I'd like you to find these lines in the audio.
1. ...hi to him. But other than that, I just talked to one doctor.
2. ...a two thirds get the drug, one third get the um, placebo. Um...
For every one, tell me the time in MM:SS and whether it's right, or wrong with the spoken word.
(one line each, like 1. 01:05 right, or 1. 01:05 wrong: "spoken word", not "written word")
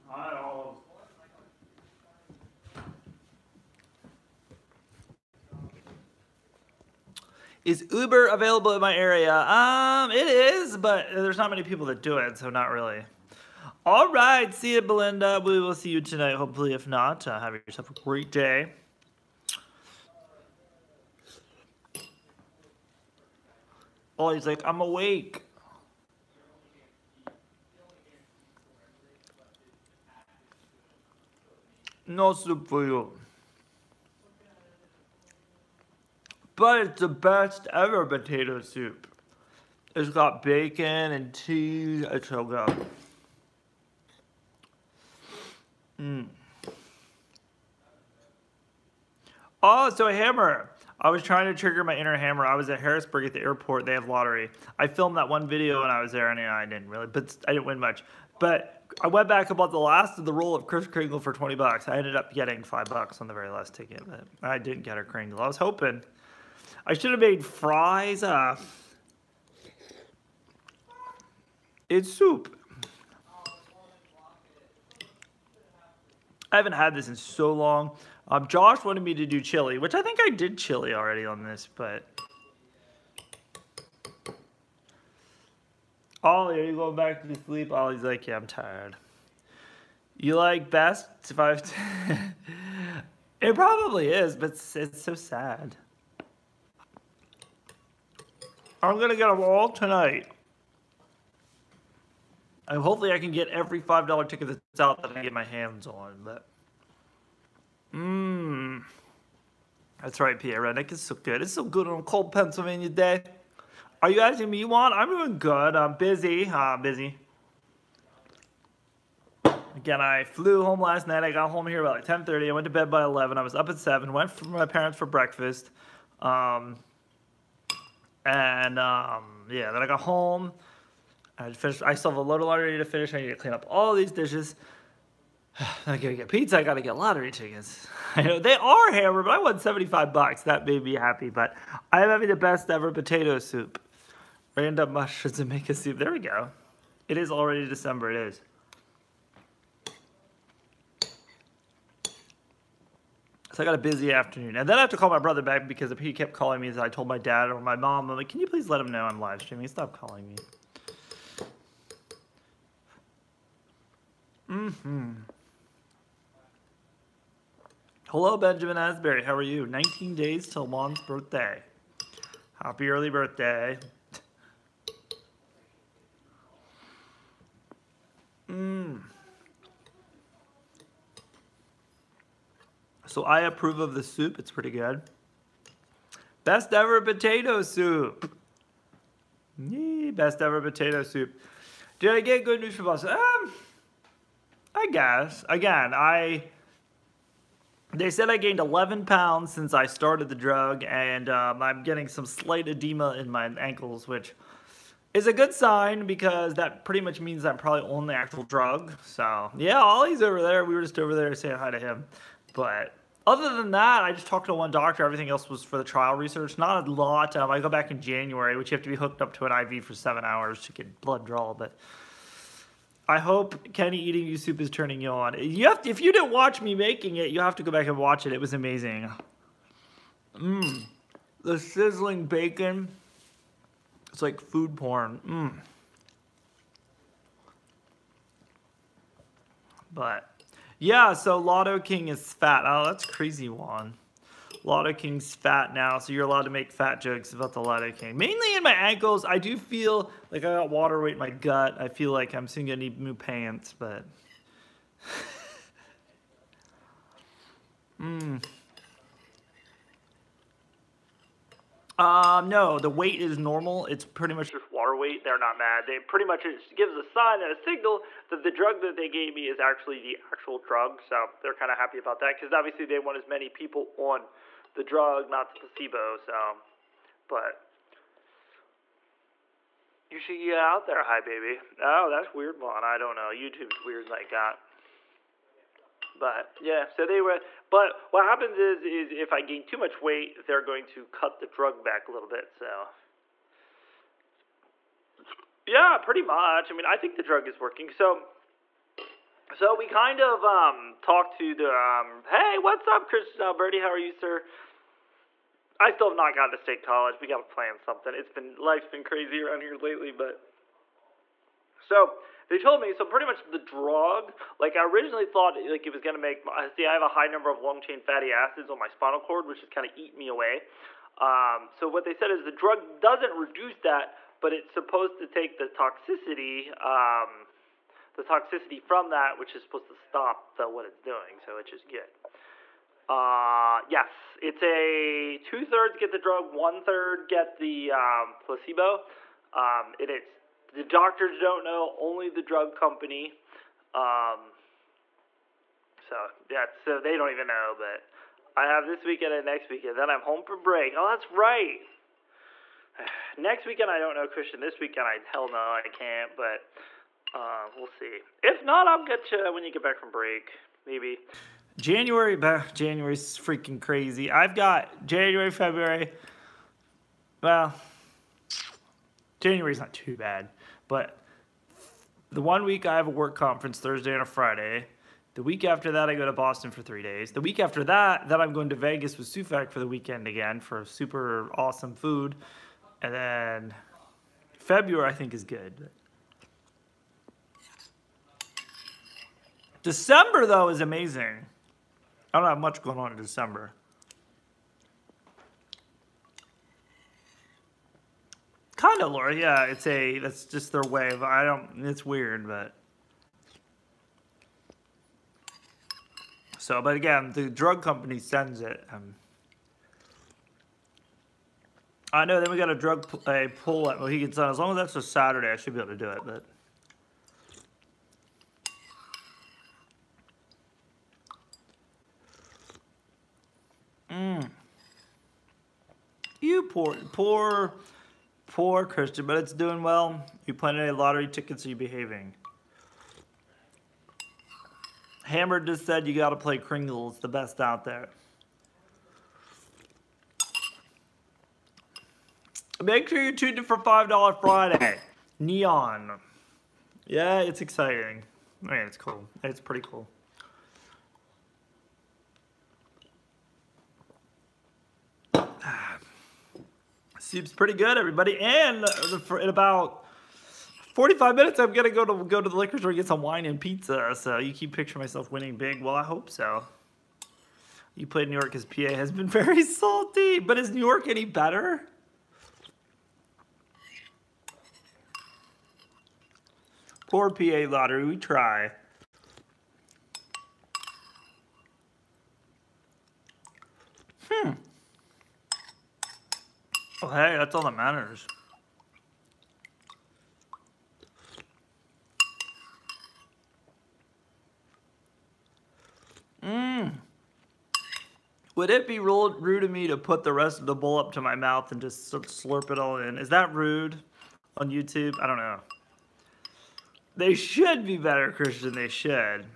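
1. 03:31 right
2. 05:34 right.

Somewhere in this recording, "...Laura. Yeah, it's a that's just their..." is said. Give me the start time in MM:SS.
06:39.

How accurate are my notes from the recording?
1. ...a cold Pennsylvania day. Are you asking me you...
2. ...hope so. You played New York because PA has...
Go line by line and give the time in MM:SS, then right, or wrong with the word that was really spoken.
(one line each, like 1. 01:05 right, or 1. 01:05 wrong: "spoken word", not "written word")
1. 01:51 right
2. 07:46 right.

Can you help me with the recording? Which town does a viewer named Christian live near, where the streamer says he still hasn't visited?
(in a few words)
State College.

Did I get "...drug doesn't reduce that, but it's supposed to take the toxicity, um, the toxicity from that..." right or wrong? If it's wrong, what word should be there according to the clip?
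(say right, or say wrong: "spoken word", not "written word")
right.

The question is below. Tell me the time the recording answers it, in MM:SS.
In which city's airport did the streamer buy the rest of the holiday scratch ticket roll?
00:52.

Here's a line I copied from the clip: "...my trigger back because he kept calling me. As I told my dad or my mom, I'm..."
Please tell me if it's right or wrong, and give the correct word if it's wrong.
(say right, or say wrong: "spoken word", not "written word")
wrong: "brother", not "trigger".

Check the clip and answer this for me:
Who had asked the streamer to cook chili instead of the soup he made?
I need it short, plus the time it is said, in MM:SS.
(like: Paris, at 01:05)
Josh, at 01:18.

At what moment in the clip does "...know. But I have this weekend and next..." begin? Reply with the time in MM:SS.
05:47.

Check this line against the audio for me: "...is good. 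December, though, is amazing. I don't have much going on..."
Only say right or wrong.
right.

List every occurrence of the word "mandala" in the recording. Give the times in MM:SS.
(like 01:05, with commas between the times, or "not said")
not said.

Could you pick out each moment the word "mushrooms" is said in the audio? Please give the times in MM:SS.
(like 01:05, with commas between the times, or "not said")
02:24.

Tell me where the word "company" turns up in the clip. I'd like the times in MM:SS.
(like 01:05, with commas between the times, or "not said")
05:42, 06:47.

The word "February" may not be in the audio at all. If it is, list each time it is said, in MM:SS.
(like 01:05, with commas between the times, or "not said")
06:05, 06:24.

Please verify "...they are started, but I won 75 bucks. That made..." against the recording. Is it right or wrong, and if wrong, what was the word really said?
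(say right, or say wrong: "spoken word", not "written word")
wrong: "hammered", not "started".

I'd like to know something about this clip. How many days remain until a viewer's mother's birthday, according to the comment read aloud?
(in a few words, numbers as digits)
19.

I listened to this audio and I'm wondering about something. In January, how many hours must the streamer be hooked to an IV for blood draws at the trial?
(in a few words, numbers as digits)
7.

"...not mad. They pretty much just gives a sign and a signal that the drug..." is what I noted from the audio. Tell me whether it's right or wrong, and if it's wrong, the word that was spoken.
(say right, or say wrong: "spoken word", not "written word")
right.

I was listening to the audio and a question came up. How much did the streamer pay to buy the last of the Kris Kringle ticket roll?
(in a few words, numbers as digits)
$20.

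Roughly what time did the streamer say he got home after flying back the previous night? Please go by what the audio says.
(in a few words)
10:30.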